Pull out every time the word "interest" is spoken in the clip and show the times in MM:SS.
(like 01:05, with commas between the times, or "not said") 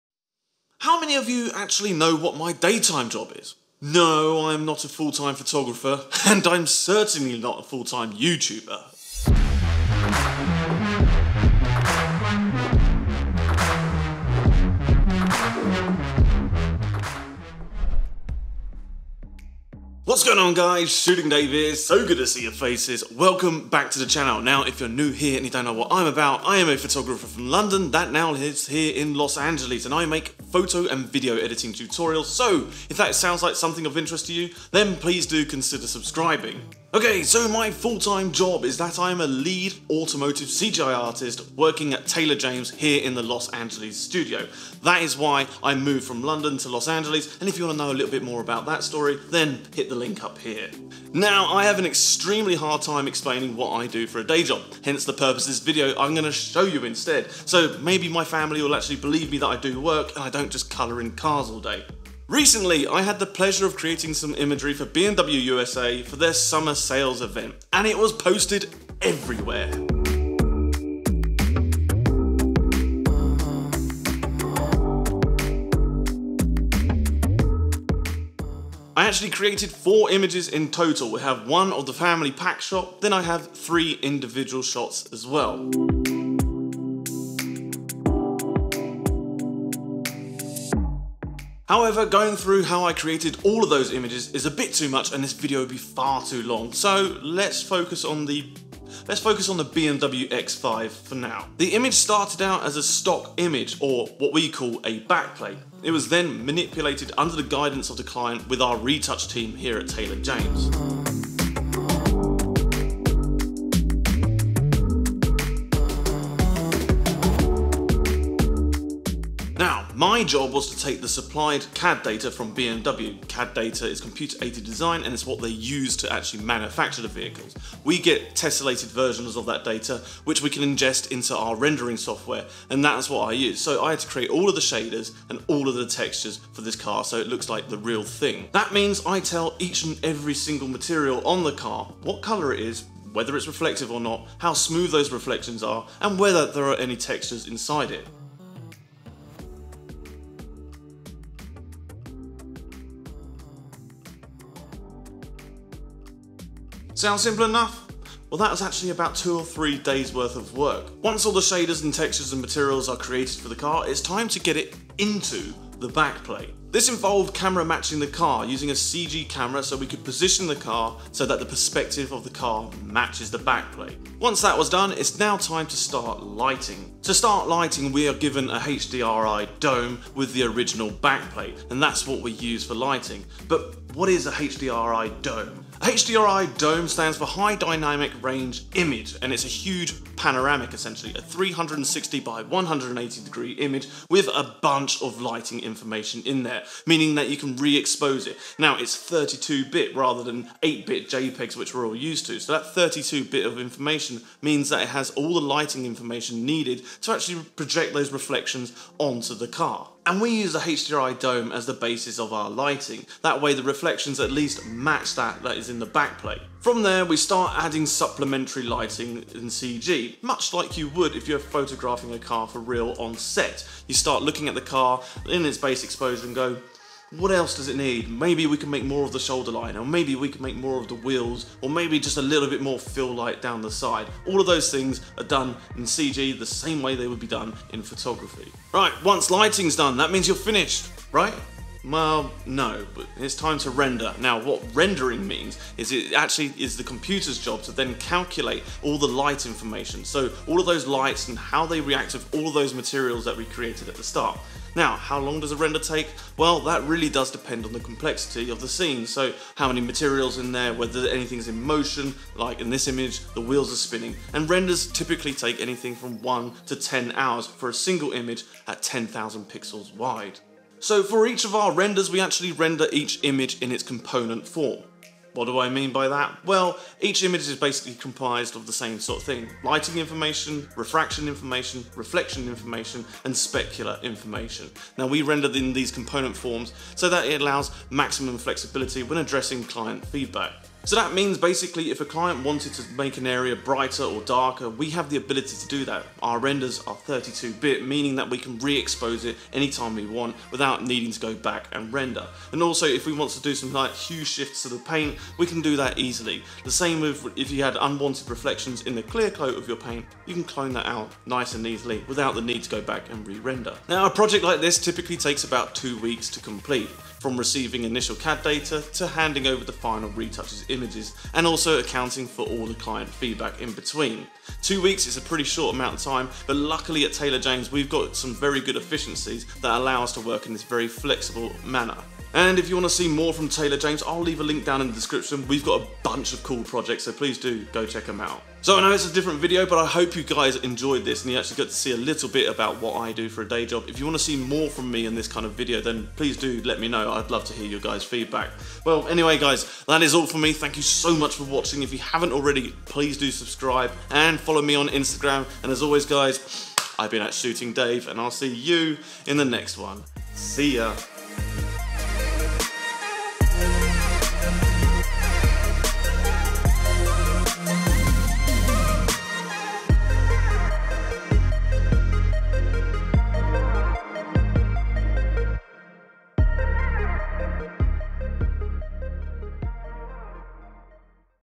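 00:33.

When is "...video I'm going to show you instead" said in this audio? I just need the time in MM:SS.
00:55.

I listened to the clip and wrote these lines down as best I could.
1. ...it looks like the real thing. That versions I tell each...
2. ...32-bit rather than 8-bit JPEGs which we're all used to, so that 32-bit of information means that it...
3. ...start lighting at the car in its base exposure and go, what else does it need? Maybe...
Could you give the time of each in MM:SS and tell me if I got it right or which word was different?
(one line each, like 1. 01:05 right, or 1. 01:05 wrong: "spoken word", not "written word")
1. 02:17 wrong: "means", not "versions"
2. 03:18 right
3. 03:43 wrong: "looking", not "lighting".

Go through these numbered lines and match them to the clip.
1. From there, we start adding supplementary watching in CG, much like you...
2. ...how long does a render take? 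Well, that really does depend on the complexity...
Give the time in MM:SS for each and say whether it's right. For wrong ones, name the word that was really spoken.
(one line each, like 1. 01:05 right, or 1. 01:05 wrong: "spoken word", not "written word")
1. 03:36 wrong: "lighting", not "watching"
2. 04:14 right.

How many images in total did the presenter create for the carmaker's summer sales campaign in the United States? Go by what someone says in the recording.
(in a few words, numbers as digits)
4.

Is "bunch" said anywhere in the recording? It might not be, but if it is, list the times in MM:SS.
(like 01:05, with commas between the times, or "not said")
03:14, 05:36.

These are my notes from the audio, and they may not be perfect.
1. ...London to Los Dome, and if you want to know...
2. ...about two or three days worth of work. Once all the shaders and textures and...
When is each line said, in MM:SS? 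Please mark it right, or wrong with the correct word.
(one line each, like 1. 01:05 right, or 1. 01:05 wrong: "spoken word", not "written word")
1. 00:46 wrong: "Angeles", not "Dome"
2. 02:38 right.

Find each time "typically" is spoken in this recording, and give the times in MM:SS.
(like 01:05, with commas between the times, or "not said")
04:24, 05:14.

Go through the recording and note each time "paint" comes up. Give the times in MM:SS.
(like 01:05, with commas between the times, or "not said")
05:04, 05:09.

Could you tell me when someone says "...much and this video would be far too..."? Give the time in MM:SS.
01:34.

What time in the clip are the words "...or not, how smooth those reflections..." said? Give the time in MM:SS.
02:23.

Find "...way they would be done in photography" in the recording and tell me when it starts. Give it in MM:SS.
03:56.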